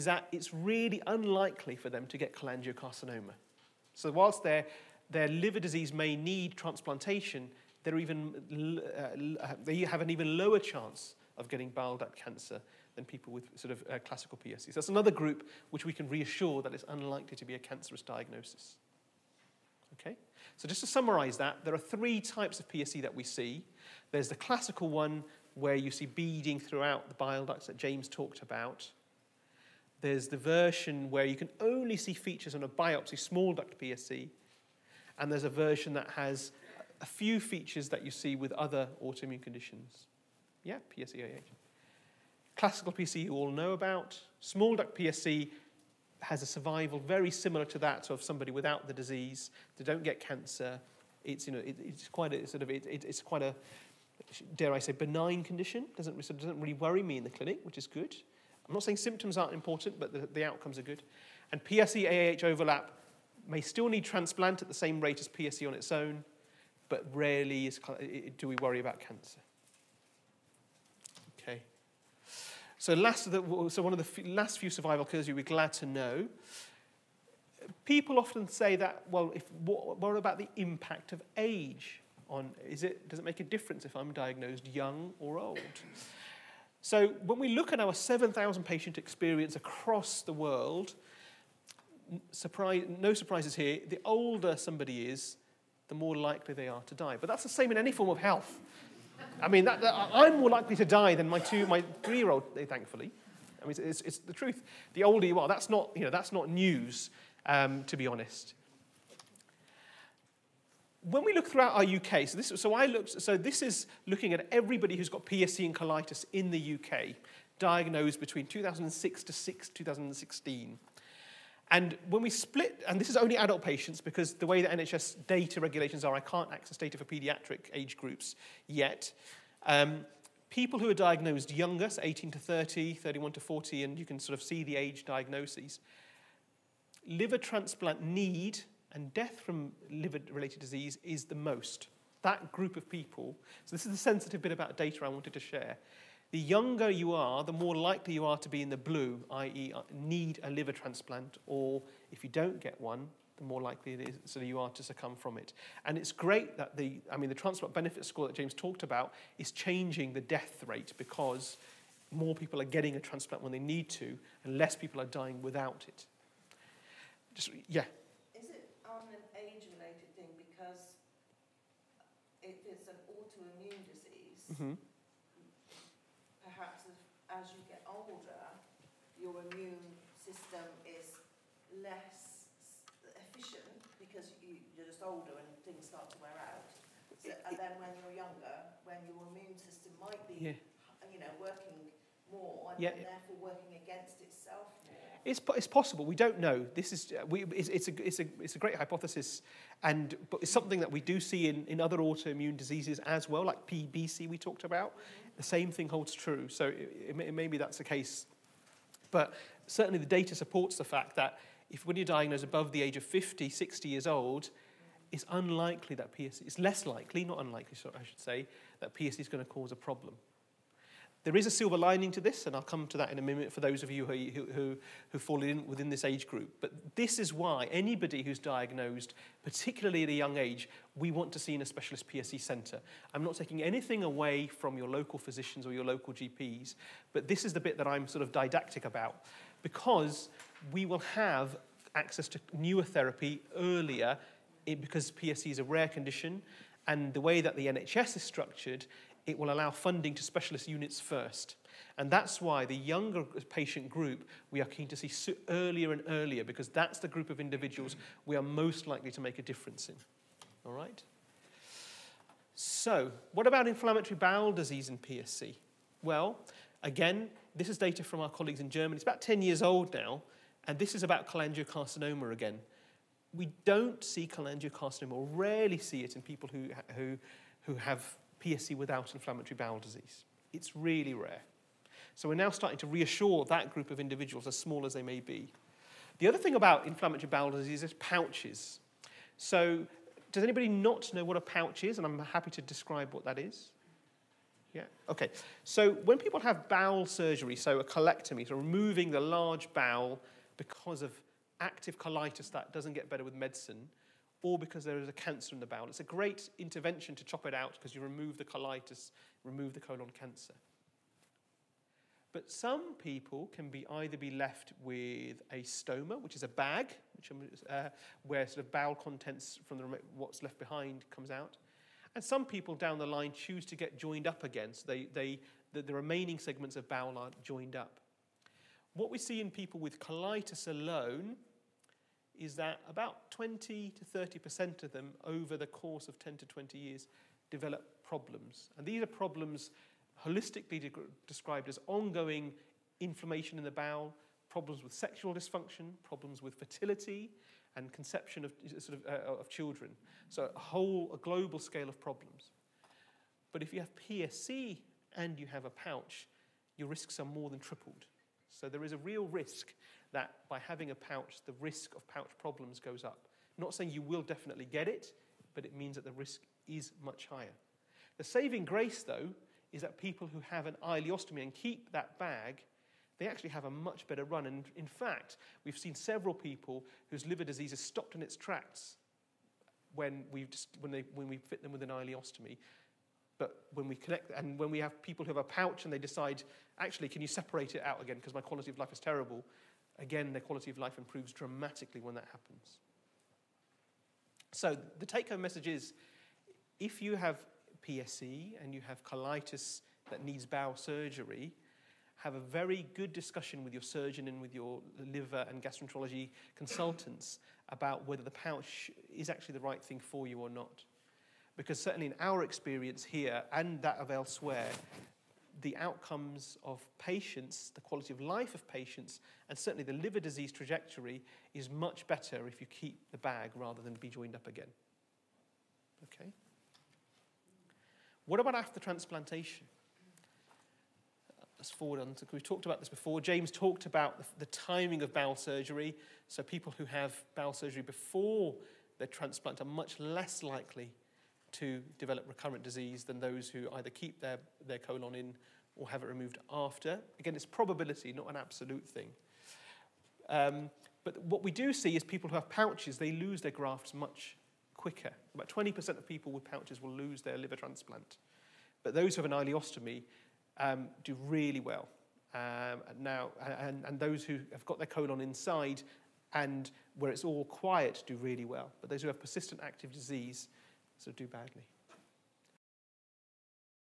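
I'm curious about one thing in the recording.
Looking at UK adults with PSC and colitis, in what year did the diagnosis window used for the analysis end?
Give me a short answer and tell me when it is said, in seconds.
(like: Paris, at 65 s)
2016, at 119 s.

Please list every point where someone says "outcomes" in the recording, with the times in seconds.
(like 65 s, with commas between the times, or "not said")
60 s, 415 s.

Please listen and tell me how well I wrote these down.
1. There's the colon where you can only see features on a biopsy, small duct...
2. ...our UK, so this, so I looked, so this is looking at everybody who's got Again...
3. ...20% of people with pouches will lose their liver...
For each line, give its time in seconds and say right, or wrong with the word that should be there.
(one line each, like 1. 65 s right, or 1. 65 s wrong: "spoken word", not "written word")
1. 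30 s wrong: "version", not "colon"
2. 111 s wrong: "PSC", not "Again"
3. 455 s right.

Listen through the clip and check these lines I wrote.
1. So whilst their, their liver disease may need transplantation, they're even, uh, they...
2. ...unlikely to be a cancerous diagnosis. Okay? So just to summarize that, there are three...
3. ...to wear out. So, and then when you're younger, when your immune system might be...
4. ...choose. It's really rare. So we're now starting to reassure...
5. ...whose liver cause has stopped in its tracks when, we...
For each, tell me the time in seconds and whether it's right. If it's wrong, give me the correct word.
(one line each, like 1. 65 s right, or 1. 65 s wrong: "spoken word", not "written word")
1. 3 s right
2. 16 s right
3. 186 s right
4. 279 s wrong: "disease", not "choose"
5. 377 s wrong: "disease", not "cause".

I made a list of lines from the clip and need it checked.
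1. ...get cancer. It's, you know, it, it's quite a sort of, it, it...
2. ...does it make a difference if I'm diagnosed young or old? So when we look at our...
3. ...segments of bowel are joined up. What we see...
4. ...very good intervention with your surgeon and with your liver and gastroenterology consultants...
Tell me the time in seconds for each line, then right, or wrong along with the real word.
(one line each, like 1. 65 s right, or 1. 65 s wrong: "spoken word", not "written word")
1. 50 s right
2. 83 s right
3. 326 s right
4. 402 s wrong: "discussion", not "intervention".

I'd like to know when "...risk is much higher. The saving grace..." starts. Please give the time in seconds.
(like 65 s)
366 s.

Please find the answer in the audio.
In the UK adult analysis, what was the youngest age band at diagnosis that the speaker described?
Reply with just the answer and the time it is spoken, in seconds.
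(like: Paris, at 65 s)
18 to 30, at 132 s.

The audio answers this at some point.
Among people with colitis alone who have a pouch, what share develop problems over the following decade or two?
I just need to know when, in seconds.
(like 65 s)
333 s.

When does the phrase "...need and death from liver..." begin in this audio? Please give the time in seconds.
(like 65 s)
138 s.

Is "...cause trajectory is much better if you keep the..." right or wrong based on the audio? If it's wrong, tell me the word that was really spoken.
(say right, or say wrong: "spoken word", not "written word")
wrong: "disease", not "cause".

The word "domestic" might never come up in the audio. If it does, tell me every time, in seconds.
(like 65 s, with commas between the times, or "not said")
not said.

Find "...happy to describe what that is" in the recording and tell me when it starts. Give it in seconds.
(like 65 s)
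292 s.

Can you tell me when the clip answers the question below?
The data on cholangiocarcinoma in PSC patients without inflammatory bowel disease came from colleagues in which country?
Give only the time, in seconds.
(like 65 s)
268 s.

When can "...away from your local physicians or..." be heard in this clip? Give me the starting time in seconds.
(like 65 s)
234 s.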